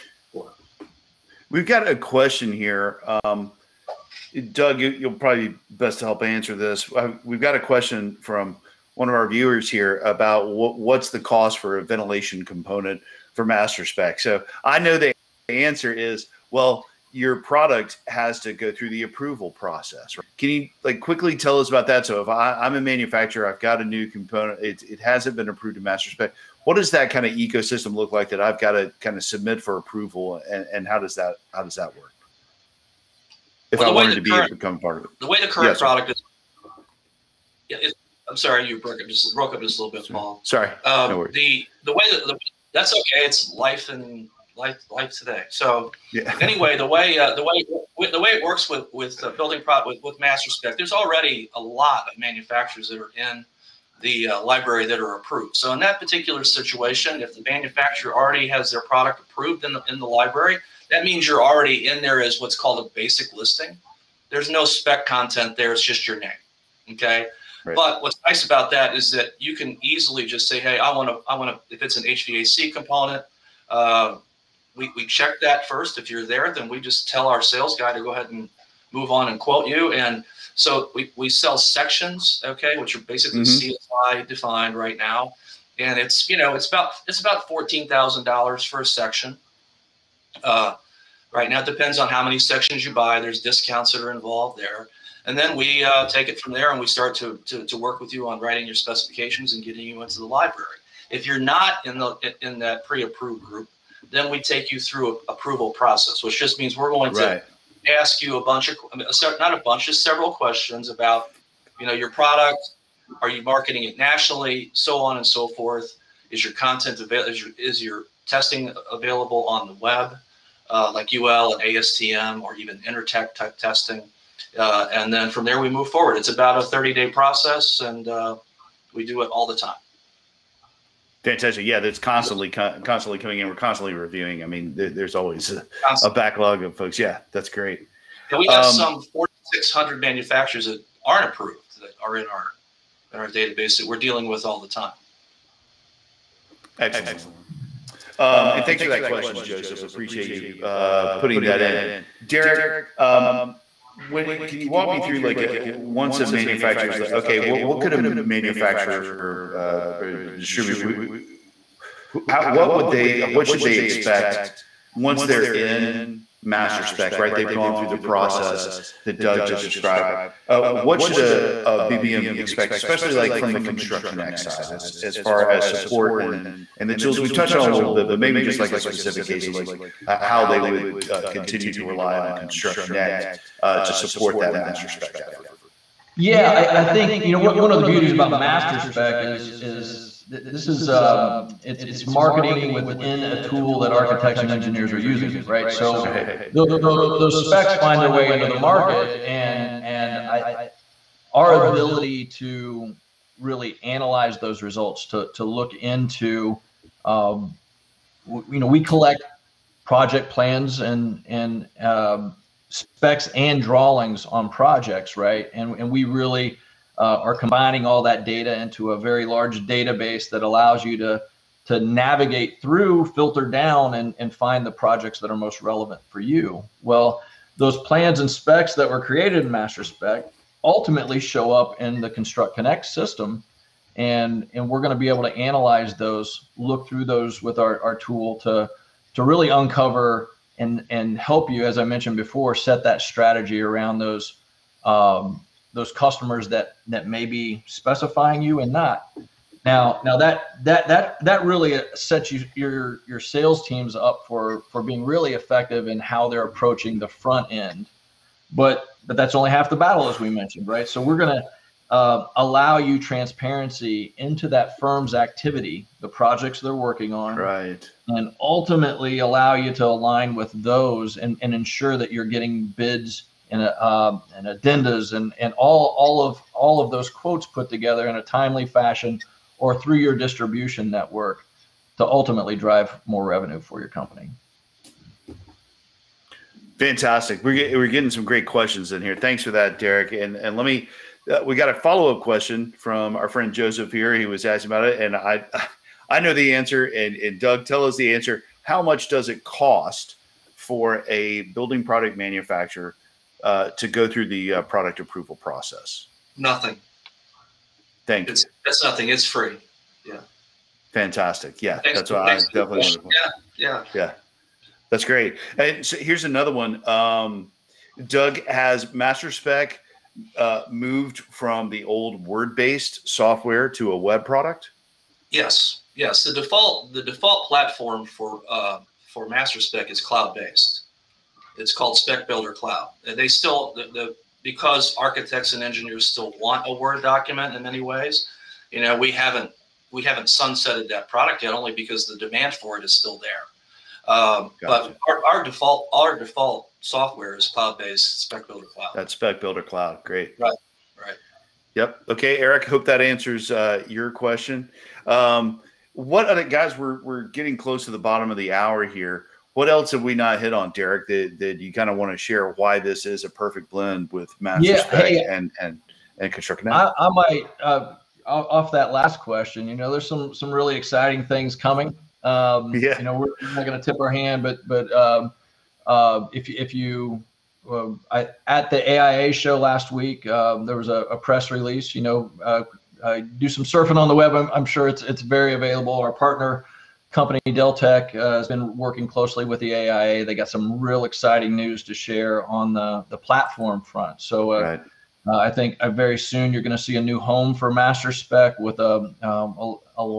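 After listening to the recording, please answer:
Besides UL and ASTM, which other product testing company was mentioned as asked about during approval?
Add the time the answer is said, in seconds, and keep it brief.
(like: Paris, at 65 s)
Intertek, at 122 s.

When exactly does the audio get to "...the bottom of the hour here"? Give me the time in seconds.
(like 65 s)
357 s.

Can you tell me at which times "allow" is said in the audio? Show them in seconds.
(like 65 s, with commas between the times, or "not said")
220 s, 262 s, 269 s.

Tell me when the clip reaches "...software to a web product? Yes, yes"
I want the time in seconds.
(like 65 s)
323 s.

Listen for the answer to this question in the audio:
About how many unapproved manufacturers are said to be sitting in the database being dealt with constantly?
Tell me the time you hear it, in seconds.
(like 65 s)
139 s.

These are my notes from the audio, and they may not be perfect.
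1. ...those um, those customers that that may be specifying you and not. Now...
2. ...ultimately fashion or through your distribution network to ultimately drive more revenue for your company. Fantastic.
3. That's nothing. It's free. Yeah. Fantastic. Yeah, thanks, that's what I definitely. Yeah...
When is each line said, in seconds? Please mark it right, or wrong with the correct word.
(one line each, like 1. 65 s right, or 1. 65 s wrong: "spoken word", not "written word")
1. 243 s right
2. 278 s wrong: "timely", not "ultimately"
3. 308 s right.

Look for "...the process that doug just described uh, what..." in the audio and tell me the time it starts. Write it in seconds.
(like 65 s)
167 s.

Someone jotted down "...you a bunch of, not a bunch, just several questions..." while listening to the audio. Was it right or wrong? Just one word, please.
right.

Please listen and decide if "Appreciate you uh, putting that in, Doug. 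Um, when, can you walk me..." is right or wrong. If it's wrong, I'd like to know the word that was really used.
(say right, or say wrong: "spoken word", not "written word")
wrong: "Derek", not "Doug".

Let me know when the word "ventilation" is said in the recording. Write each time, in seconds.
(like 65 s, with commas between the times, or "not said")
11 s.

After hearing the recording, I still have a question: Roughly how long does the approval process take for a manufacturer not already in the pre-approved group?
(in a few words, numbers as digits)
30 days.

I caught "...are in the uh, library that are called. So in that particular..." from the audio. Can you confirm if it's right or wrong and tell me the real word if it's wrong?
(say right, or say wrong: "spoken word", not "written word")
wrong: "approved", not "called".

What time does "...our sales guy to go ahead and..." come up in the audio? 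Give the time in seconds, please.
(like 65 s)
77 s.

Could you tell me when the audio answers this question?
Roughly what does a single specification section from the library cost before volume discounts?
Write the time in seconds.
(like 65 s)
87 s.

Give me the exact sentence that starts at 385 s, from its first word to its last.
Our partner company Deltek uh, has been working closely with the AIA.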